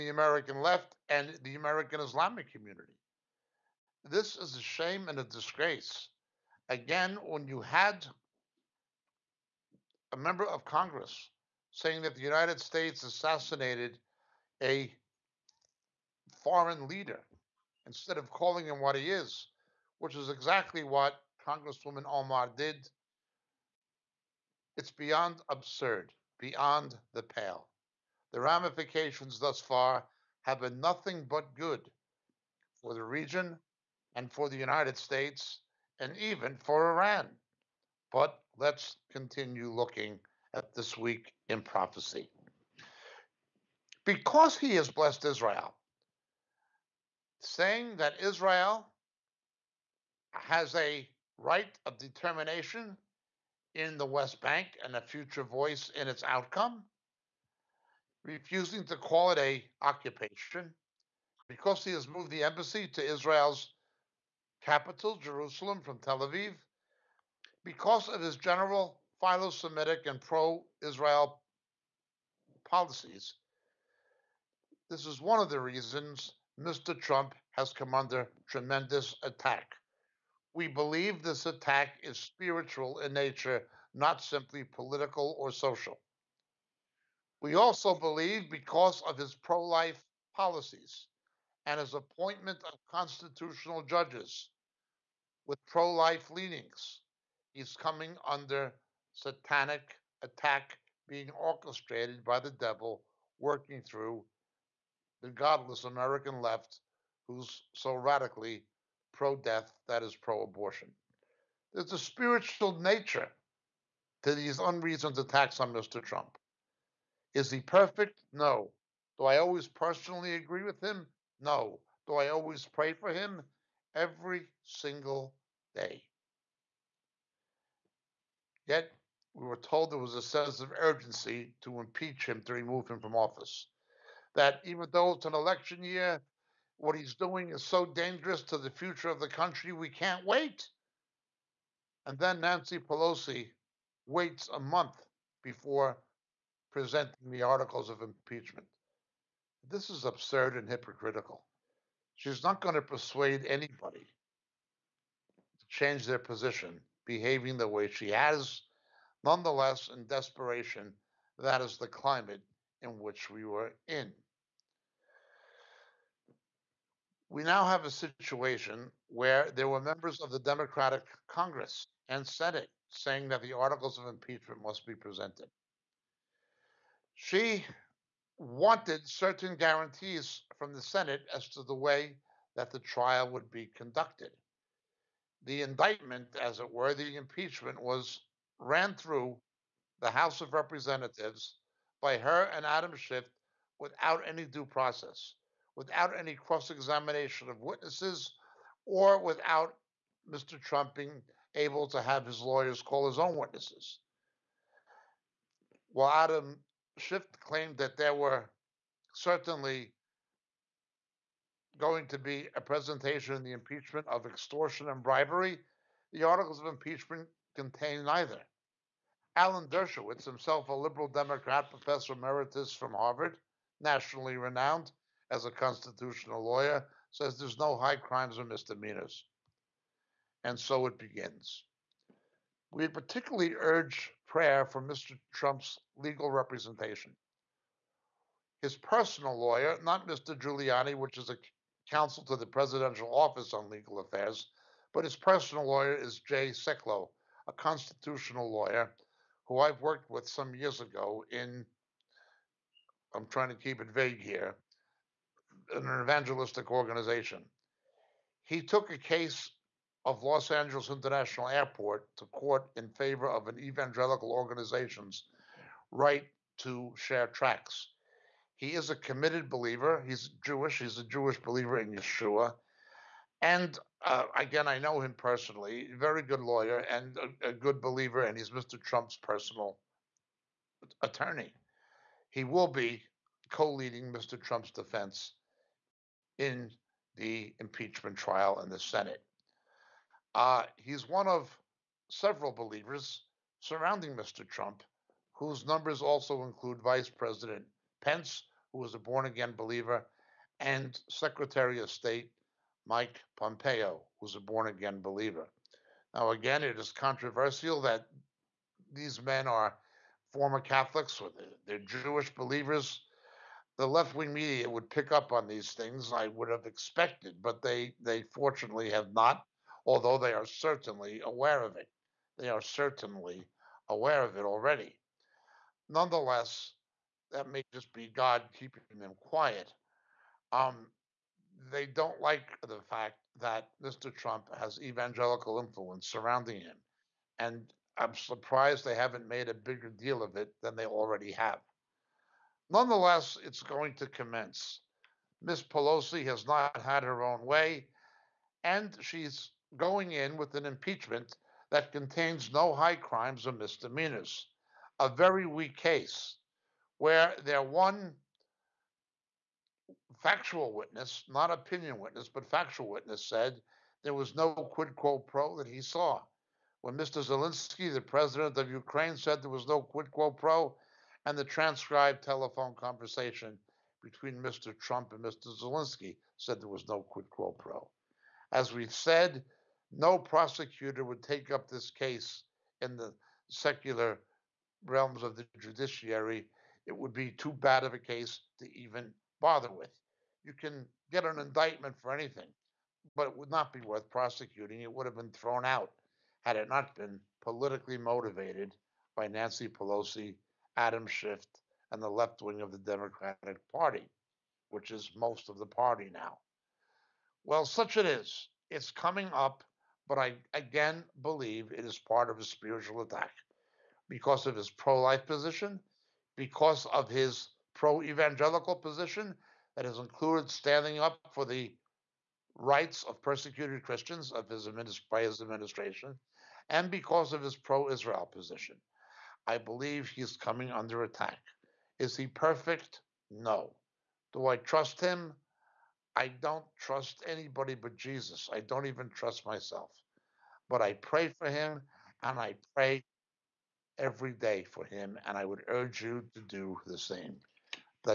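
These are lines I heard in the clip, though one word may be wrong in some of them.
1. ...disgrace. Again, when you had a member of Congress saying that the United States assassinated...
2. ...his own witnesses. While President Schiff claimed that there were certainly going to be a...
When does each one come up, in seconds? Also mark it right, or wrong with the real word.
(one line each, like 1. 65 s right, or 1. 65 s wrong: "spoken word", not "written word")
1. 5 s right
2. 203 s wrong: "Adam", not "President".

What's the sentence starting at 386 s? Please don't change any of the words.
It would be too bad of a case to even bother with.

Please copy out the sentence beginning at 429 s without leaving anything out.
I believe he's coming under attack.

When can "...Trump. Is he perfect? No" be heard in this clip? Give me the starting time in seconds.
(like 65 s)
116 s.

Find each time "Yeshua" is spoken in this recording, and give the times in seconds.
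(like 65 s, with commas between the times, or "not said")
271 s.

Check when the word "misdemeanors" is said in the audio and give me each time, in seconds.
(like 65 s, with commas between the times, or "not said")
228 s, 353 s.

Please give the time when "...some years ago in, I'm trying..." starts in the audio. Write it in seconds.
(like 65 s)
250 s.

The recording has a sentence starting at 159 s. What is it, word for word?
Nonetheless, in desperation, that is the climate in which we were in.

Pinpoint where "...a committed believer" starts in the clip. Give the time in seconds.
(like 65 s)
268 s.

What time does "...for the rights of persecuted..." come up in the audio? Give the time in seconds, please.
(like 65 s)
421 s.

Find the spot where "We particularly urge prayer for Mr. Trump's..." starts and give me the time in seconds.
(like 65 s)
232 s.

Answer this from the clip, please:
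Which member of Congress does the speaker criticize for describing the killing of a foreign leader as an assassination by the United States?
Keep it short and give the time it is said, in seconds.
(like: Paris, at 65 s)
Congresswoman Omar, at 21 s.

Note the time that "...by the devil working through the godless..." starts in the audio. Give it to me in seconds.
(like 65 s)
102 s.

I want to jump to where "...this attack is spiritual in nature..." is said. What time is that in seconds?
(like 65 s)
81 s.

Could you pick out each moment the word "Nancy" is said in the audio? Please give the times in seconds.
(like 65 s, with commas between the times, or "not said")
142 s, 399 s.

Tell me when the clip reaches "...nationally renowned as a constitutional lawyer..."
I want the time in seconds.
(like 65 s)
223 s.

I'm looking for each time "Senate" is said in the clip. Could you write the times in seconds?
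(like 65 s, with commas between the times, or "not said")
172 s, 180 s, 288 s.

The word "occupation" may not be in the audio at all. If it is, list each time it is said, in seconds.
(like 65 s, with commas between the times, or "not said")
59 s.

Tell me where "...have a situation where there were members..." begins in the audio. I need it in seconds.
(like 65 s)
167 s.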